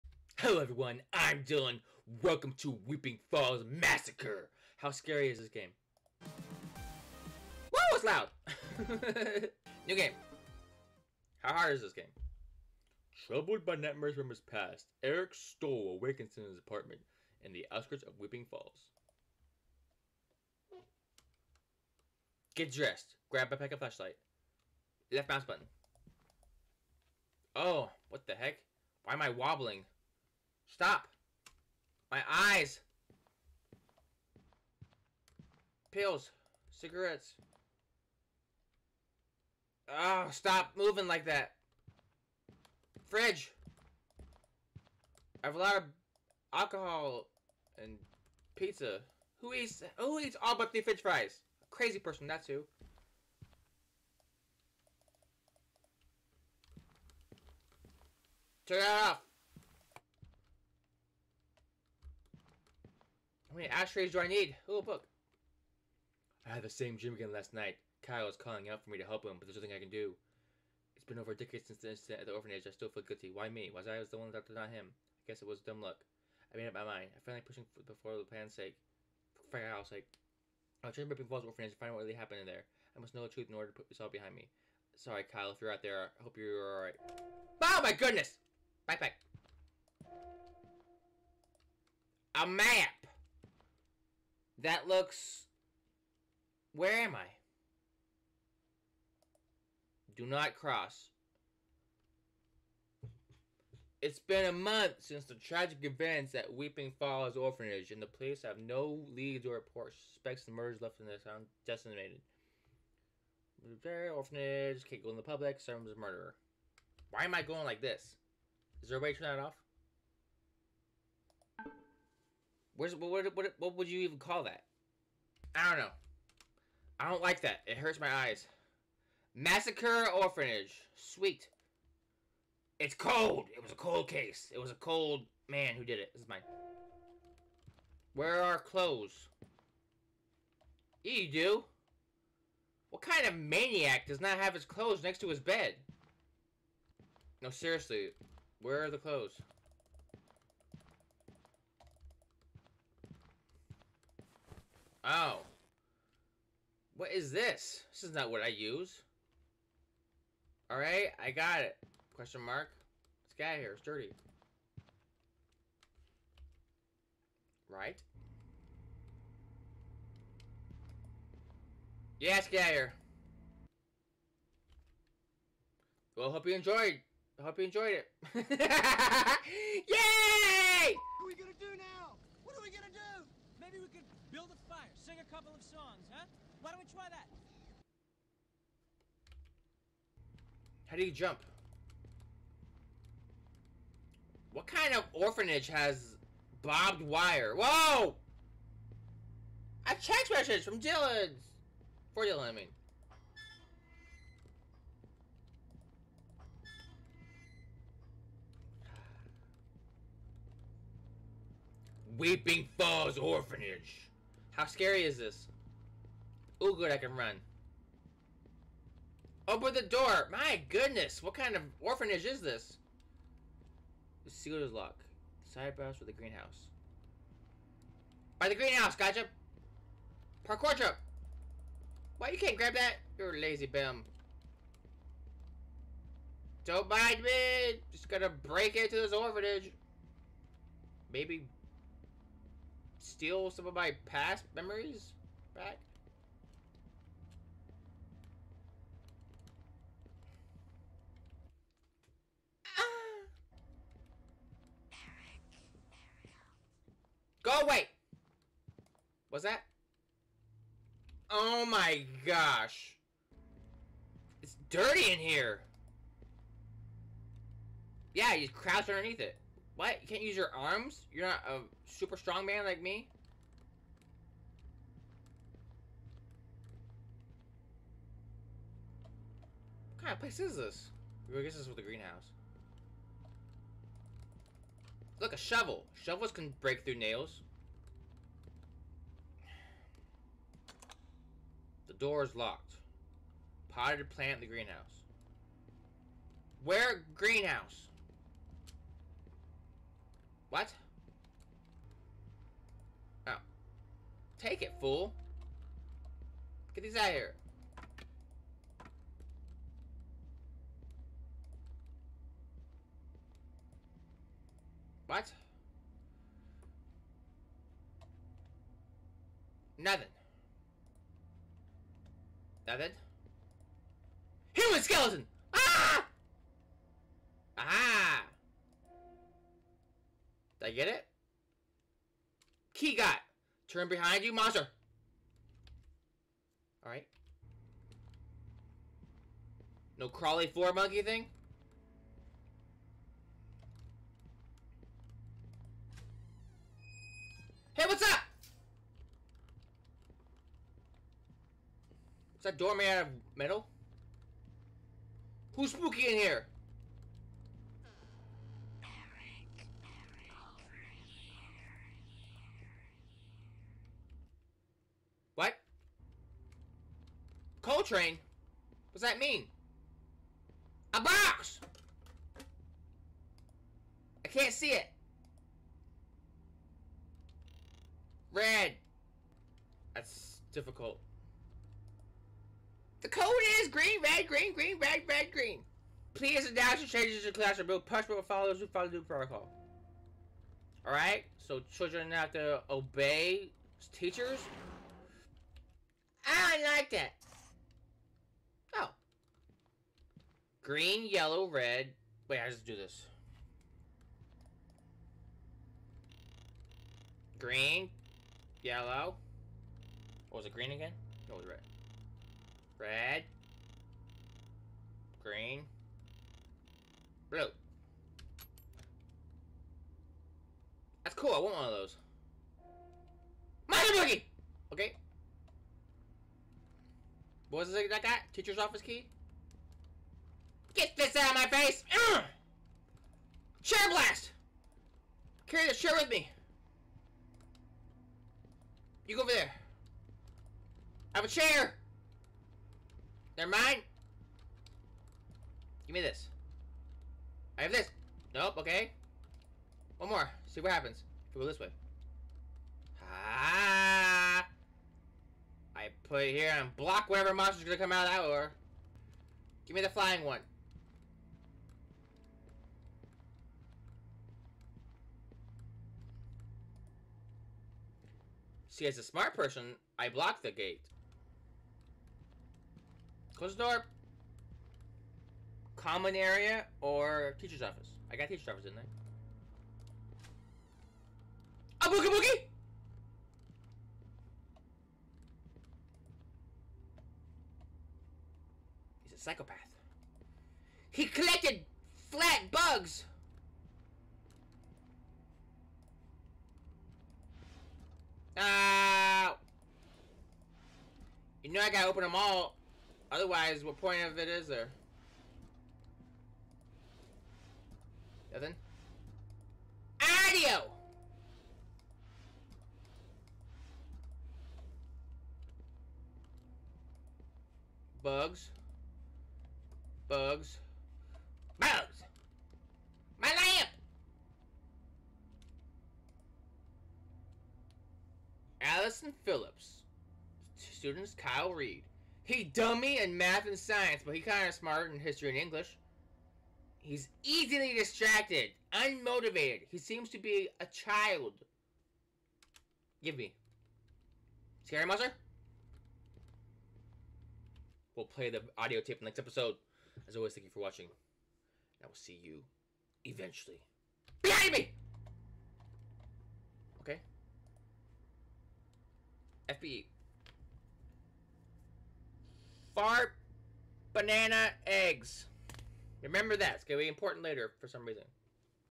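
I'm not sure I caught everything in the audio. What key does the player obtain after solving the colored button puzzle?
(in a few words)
Teacher's office key.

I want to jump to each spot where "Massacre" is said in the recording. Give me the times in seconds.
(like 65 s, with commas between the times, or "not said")
3 s, 129 s.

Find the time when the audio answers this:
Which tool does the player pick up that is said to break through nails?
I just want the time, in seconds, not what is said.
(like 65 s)
285 s.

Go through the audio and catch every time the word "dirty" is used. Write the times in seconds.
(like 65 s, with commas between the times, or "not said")
163 s, 264 s.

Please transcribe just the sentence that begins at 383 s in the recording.
The code is green, red, green, green, red, red, green.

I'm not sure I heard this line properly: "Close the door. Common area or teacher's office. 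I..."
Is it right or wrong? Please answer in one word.
right.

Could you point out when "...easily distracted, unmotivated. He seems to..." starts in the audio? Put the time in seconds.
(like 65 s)
537 s.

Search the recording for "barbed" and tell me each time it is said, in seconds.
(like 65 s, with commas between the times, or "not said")
196 s.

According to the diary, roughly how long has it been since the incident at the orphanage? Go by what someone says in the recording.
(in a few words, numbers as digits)
over a decade.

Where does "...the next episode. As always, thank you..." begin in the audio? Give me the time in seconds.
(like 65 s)
549 s.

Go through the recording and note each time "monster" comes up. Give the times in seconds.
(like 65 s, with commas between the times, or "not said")
334 s, 457 s, 544 s.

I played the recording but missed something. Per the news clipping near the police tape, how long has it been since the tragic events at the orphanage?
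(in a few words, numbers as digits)
a month.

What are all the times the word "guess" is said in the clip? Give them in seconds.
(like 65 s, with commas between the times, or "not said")
75 s, 281 s.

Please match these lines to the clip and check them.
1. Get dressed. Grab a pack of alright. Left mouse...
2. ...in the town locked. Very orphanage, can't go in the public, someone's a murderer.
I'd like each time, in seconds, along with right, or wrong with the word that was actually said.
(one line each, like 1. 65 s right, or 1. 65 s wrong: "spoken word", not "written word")
1. 22 s wrong: "flashlight", not "alright"
2. 110 s wrong: "decimated", not "locked".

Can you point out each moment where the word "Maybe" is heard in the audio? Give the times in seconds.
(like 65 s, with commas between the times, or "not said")
183 s, 241 s.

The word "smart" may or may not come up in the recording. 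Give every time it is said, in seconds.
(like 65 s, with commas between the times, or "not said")
469 s, 534 s.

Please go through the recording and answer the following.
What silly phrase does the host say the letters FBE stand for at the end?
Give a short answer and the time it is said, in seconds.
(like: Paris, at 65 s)
fart banana eggs, at 562 s.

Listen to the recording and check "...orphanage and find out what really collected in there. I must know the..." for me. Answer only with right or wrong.
wrong.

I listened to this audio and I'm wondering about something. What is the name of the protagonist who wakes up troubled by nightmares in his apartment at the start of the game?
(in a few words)
Eric Stoll.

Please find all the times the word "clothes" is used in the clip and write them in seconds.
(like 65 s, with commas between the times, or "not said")
138 s, 144 s, 148 s.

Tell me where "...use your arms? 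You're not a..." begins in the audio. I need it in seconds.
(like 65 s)
270 s.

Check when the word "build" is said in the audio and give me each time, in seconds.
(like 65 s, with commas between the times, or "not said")
184 s, 387 s.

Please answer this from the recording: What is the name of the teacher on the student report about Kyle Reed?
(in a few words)
Allison Phillips.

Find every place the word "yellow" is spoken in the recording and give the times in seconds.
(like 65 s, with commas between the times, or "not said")
401 s, 408 s.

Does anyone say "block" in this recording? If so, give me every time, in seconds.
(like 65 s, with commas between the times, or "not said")
456 s, 470 s.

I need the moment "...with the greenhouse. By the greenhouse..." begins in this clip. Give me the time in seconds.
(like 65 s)
225 s.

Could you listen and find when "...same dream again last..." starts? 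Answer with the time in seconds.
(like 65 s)
66 s.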